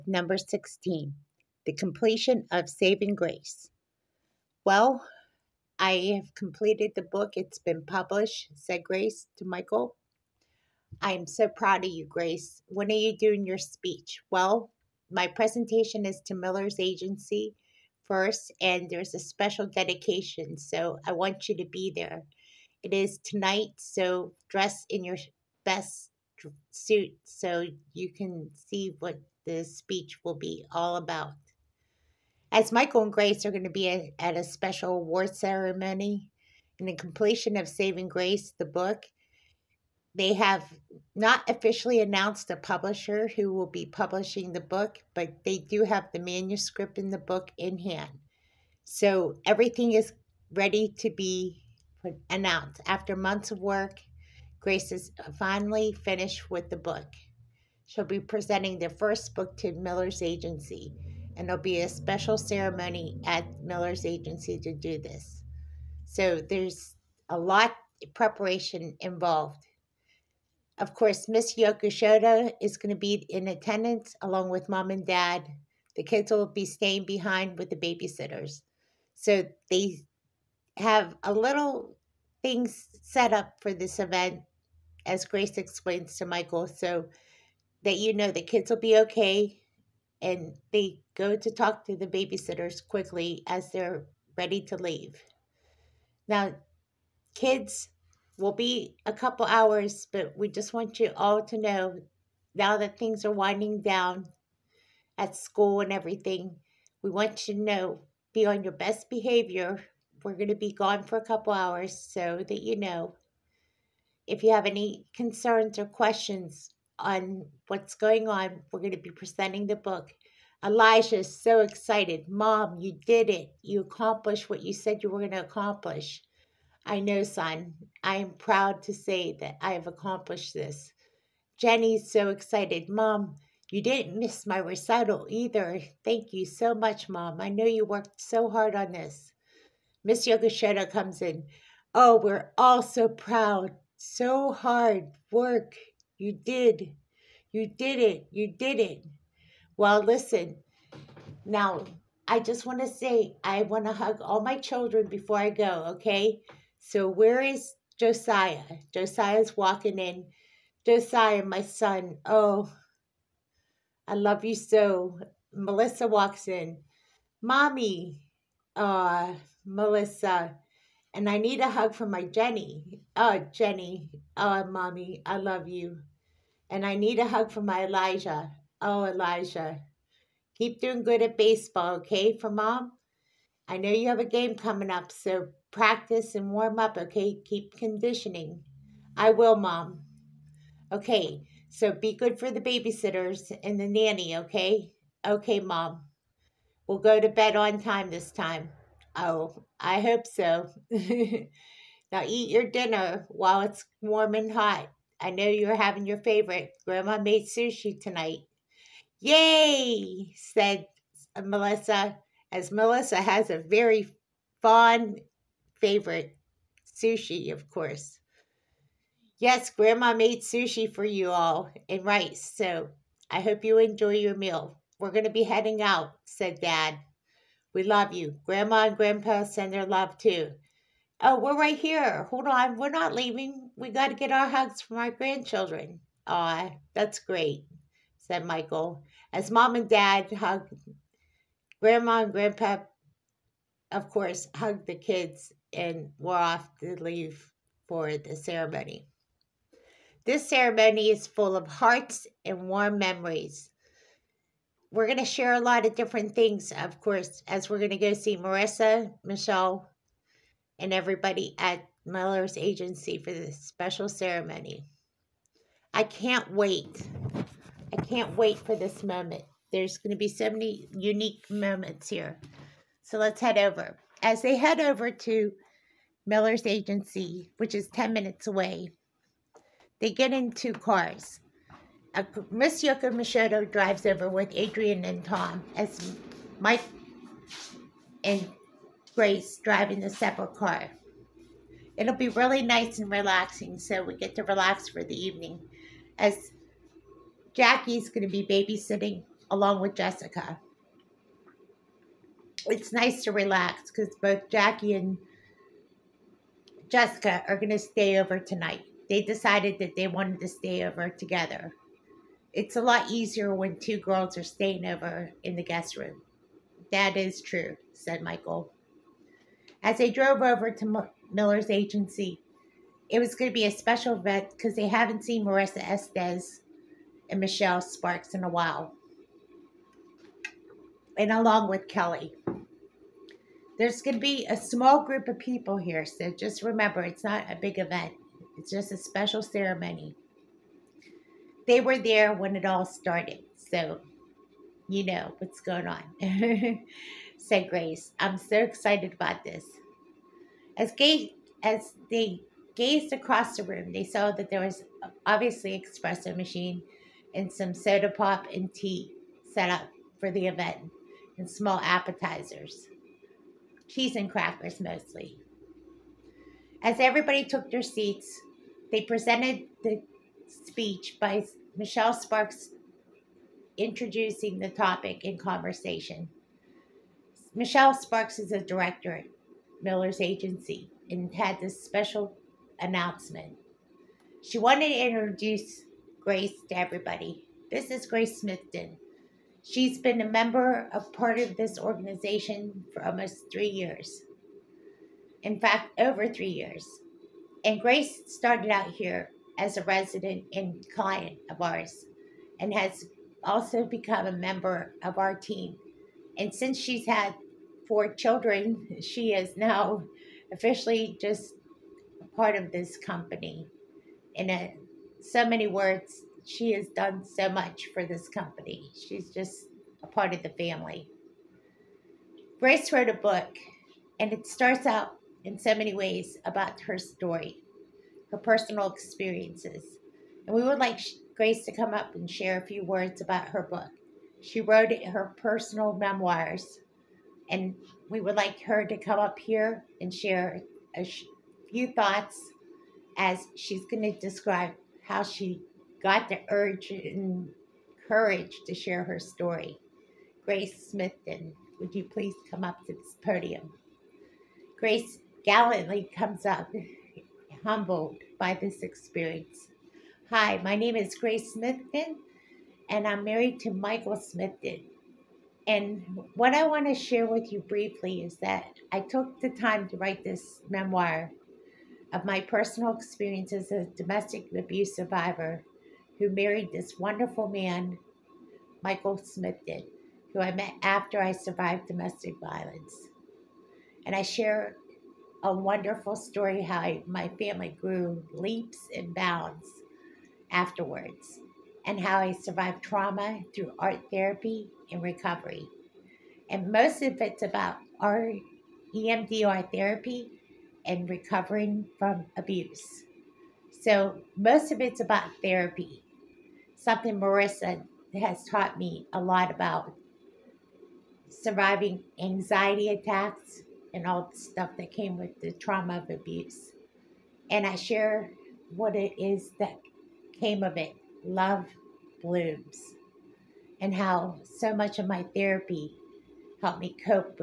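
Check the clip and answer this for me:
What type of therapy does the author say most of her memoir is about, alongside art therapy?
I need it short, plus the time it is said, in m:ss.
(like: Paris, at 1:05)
EMDR therapy, at 8:18.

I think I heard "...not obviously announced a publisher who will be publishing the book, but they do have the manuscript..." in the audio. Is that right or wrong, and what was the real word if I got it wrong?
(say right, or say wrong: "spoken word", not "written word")
wrong: "officially", not "obviously".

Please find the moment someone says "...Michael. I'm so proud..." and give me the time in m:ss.
0:09.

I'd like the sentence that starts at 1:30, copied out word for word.
And they go to talk to the babysitters quickly as they're ready to leave.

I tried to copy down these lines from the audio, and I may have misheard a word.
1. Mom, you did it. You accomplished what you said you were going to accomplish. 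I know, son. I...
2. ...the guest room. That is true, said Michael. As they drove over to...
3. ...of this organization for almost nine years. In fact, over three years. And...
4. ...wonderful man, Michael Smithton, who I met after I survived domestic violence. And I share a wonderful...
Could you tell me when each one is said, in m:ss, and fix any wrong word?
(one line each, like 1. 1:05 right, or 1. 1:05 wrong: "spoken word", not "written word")
1. 2:02 right
2. 5:15 right
3. 6:31 wrong: "three", not "nine"
4. 7:56 right.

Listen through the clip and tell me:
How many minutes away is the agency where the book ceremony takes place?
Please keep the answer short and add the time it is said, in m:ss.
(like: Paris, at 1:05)
10, at 4:37.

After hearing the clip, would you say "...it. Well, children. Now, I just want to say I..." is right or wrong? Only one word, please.
wrong.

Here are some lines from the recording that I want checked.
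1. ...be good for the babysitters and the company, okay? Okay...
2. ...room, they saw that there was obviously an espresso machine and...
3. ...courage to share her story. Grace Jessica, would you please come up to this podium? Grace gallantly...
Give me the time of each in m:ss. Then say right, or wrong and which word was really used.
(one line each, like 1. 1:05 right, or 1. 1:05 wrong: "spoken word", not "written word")
1. 3:11 wrong: "nanny", not "company"
2. 5:53 right
3. 7:28 wrong: "Smithton", not "Jessica".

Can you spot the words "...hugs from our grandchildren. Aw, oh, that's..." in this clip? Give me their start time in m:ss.
3:54.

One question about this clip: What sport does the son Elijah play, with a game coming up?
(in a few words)
Baseball.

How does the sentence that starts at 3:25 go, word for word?
I know you're having your favorite.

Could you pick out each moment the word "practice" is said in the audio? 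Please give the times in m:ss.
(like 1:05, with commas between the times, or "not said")
3:05.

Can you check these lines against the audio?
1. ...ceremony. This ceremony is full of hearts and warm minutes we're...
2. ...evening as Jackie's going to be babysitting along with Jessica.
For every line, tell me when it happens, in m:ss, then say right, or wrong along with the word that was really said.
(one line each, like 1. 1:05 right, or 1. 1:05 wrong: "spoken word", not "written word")
1. 4:08 wrong: "memories", not "minutes"
2. 4:55 right.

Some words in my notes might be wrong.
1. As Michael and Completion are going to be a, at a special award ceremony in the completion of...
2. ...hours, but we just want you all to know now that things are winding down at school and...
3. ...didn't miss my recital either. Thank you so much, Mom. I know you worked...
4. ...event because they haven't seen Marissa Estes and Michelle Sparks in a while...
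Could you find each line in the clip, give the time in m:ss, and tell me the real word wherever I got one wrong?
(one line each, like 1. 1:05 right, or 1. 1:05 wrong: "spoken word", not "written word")
1. 0:32 wrong: "Grace", not "Completion"
2. 1:39 right
3. 2:13 right
4. 5:24 right.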